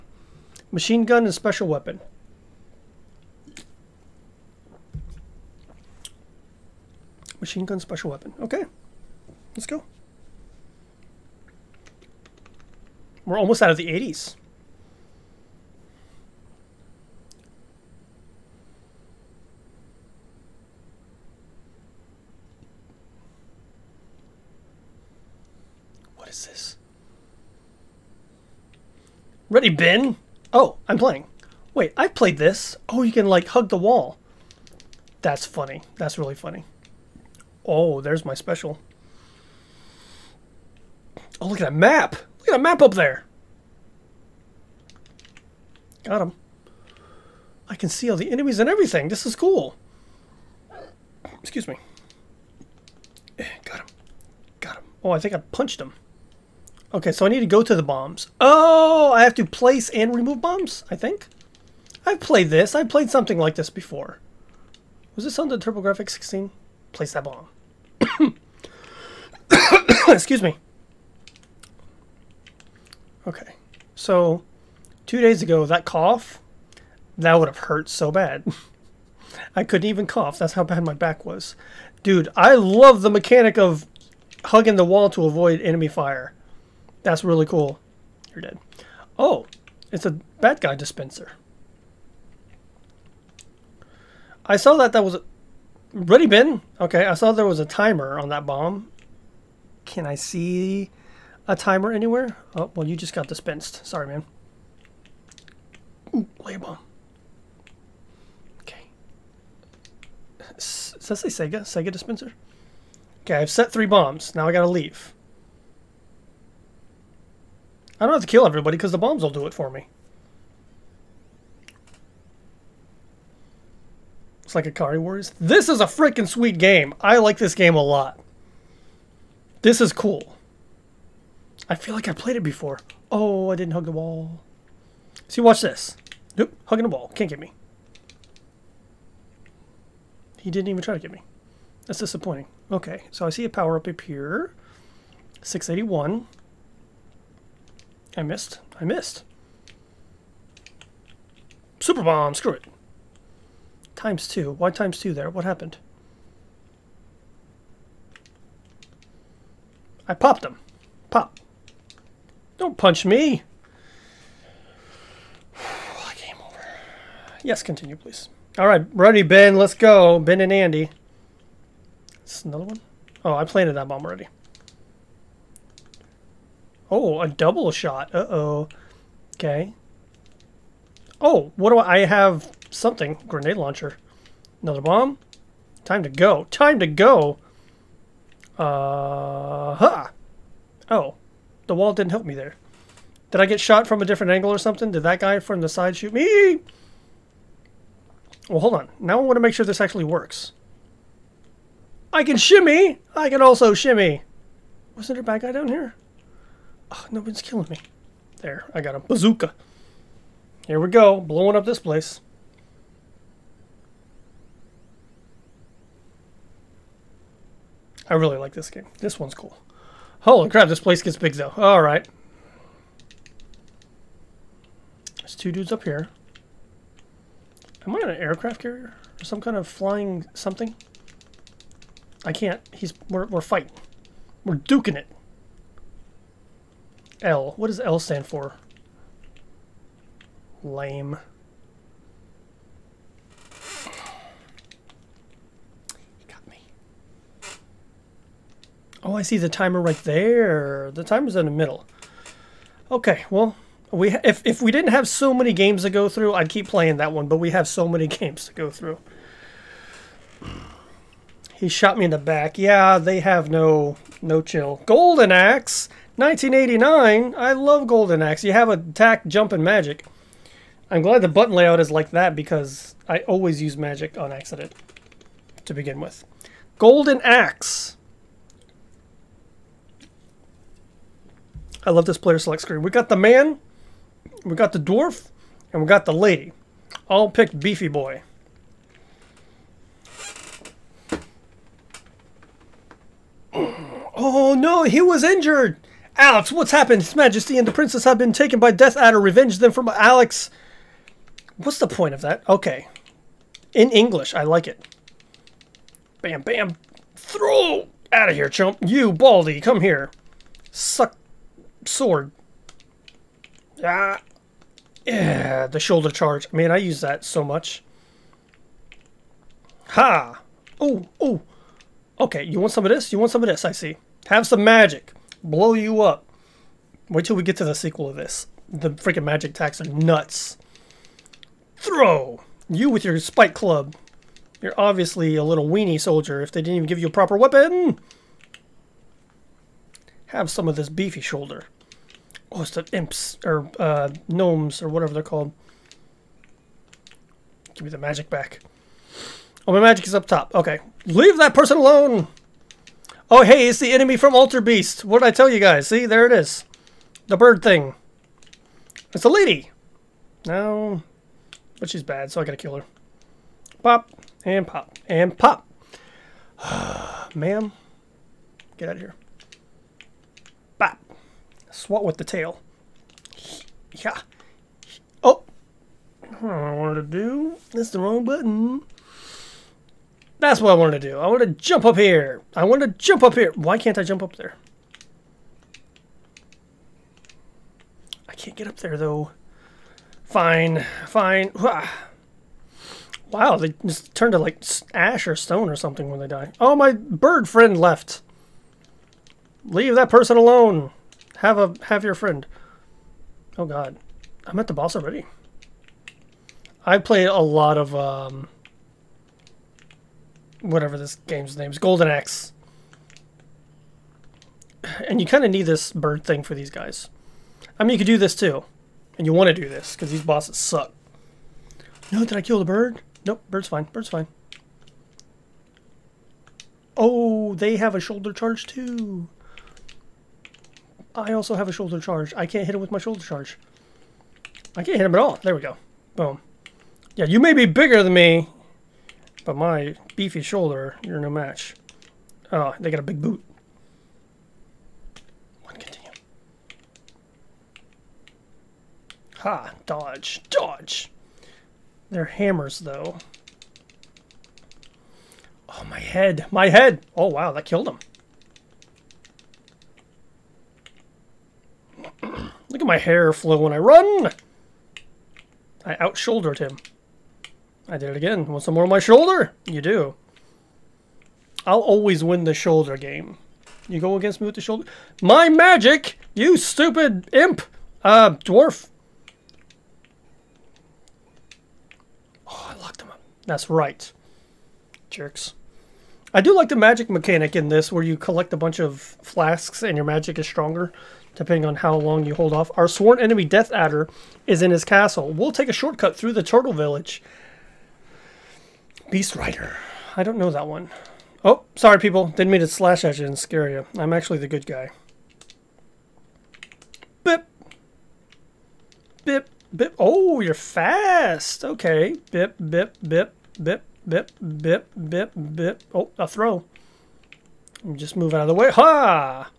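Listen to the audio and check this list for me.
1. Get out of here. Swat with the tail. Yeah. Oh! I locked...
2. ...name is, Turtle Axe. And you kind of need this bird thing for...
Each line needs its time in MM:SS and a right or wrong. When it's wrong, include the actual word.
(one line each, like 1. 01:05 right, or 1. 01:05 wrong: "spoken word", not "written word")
1. 06:08 wrong: "wanted", not "locked"
2. 06:51 wrong: "Golden", not "Turtle".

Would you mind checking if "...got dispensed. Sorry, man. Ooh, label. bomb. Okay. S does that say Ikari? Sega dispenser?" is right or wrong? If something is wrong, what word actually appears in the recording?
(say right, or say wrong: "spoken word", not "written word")
wrong: "Sega", not "Ikari".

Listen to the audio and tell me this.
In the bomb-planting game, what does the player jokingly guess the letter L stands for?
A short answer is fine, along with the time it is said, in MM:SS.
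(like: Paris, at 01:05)
Lame, at 04:00.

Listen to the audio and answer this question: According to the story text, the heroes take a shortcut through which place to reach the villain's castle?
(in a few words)
Turtle Village.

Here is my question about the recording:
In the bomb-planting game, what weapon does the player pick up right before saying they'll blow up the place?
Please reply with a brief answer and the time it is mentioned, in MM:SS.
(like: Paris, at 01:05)
bazooka, at 03:29.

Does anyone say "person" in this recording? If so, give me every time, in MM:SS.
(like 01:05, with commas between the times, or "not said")
05:51, 06:40.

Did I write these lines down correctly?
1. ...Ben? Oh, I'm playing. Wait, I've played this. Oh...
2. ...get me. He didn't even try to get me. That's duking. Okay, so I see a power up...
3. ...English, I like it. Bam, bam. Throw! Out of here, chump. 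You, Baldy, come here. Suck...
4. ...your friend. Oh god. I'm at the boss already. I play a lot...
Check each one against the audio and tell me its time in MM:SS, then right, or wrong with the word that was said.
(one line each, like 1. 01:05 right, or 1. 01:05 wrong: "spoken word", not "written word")
1. 00:29 right
2. 02:17 wrong: "disappointing", not "duking"
3. 05:03 right
4. 06:42 right.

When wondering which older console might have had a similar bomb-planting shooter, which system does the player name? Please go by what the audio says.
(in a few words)
TurboGrafx 16.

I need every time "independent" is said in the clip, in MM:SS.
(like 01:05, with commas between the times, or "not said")
not said.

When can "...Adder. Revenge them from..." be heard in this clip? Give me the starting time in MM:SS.
04:58.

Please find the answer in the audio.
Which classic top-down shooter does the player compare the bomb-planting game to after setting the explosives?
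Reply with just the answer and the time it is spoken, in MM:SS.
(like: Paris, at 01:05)
Ikari Warriors, at 02:04.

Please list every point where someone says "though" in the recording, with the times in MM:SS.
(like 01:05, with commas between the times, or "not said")
03:41, 06:28, 07:32.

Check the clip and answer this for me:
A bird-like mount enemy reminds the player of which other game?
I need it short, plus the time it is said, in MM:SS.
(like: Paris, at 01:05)
Altered Beast, at 05:54.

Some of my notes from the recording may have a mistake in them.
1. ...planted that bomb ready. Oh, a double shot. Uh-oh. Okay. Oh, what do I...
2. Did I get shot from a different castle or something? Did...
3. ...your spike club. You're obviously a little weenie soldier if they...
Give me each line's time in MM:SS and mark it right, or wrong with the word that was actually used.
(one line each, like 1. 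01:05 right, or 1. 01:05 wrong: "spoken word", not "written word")
1. 02:53 wrong: "already", not "ready"
2. 03:13 wrong: "angle", not "castle"
3. 05:33 right.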